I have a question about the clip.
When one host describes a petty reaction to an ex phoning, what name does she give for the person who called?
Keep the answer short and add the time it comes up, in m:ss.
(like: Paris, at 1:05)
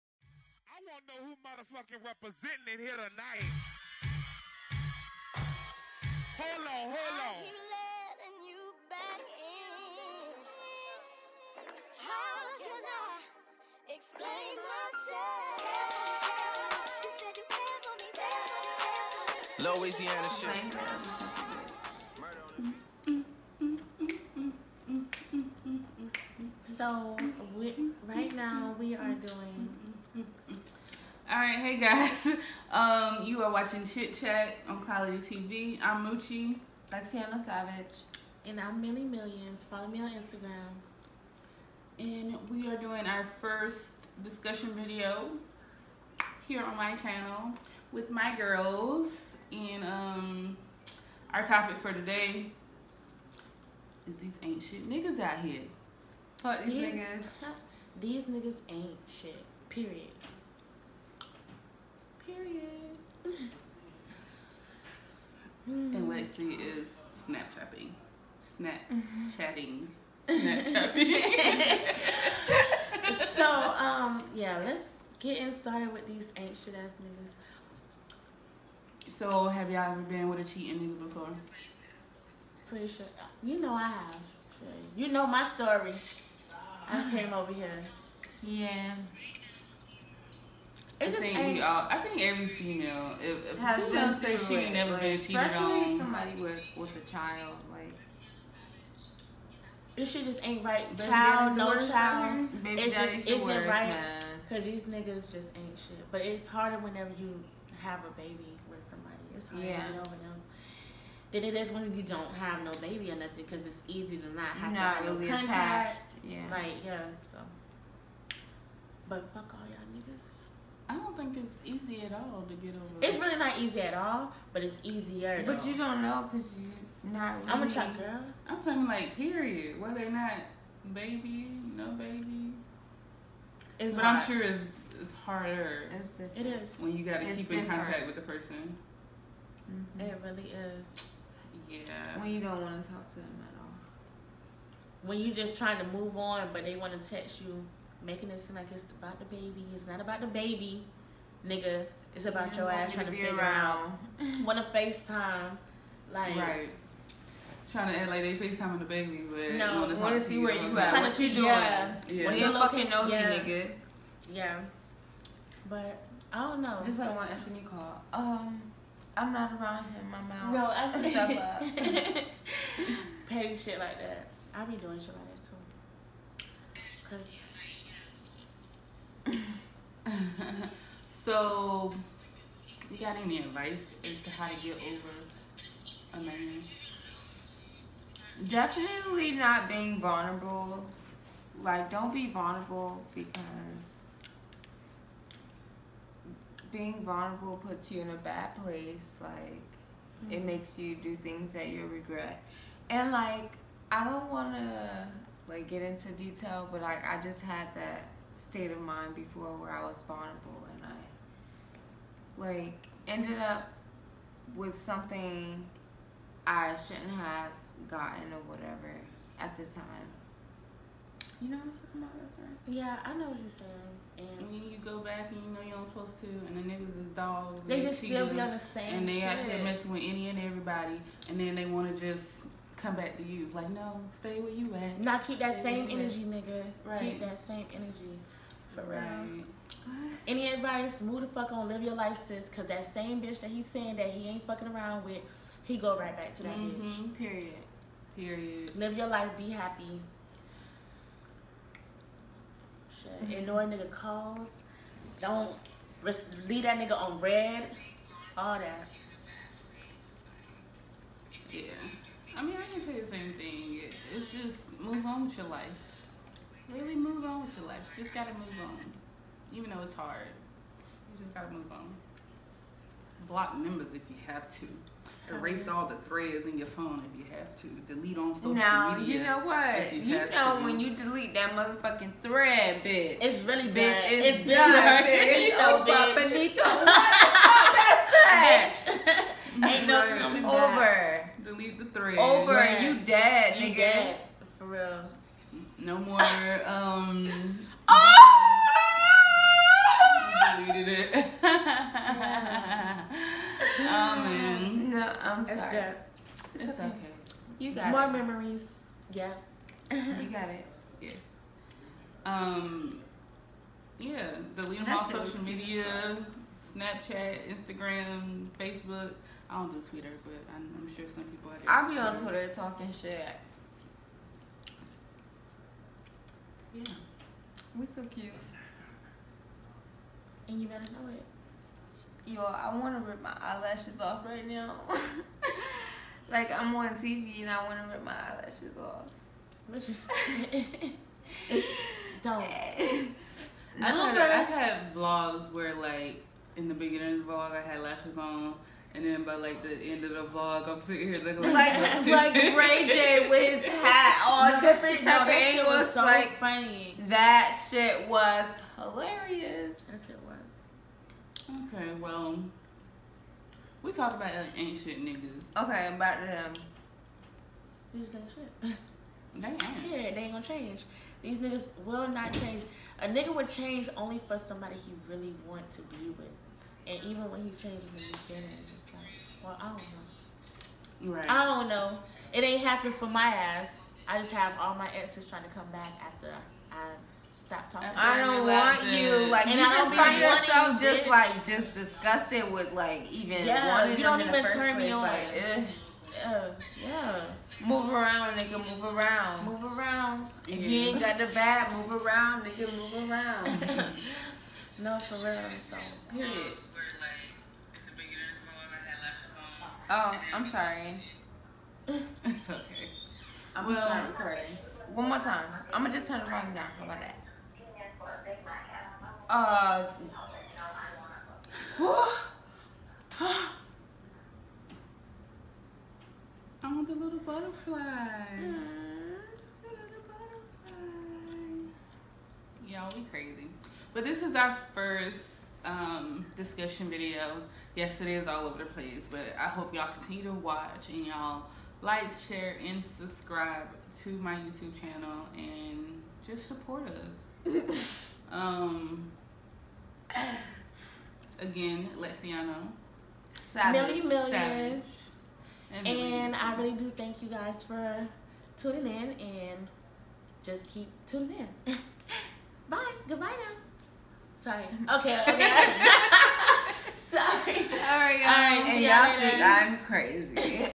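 Anthony, at 2:47.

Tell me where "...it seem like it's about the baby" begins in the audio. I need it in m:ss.
2:28.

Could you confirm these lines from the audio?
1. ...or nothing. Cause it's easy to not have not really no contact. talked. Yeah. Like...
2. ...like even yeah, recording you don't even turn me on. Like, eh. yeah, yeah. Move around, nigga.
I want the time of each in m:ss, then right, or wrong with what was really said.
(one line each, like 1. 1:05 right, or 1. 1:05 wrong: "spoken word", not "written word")
1. 1:53 wrong: "attached", not "talked"
2. 6:32 wrong: "wanting", not "recording".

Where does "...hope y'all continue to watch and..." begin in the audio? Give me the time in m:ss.
7:19.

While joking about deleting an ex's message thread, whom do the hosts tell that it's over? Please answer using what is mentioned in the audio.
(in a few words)
Benito.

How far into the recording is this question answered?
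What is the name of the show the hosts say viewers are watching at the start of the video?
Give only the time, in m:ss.
0:33.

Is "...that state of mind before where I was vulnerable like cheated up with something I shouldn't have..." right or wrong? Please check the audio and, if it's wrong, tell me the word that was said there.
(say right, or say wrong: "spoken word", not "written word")
wrong: "ended", not "cheated".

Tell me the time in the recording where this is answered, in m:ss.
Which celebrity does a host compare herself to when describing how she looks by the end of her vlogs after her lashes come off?
5:52.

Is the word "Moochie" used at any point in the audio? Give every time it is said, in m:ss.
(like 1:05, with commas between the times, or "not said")
0:36.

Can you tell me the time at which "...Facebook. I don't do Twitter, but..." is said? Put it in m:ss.
5:18.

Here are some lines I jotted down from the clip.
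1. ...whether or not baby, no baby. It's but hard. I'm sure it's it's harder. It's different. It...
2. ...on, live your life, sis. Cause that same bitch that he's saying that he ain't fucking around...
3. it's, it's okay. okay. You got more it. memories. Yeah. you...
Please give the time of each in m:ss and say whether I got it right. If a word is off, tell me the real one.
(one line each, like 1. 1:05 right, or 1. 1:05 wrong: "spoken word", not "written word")
1. 2:09 right
2. 4:01 right
3. 5:06 right.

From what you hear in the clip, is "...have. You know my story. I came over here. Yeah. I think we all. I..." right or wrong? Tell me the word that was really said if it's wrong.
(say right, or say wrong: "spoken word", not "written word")
right.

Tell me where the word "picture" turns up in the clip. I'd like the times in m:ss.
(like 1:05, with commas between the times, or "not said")
not said.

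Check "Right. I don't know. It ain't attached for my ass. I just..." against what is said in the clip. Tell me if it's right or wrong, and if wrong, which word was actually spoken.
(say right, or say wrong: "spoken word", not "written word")
wrong: "happened", not "attached".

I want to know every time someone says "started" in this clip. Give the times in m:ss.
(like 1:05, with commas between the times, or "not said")
1:15.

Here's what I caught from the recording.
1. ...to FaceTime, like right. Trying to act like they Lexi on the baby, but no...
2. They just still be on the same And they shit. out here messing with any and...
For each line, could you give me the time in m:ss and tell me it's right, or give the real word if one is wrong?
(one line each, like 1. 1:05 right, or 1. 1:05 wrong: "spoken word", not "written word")
1. 2:34 wrong: "FaceTime", not "Lexi"
2. 3:47 right.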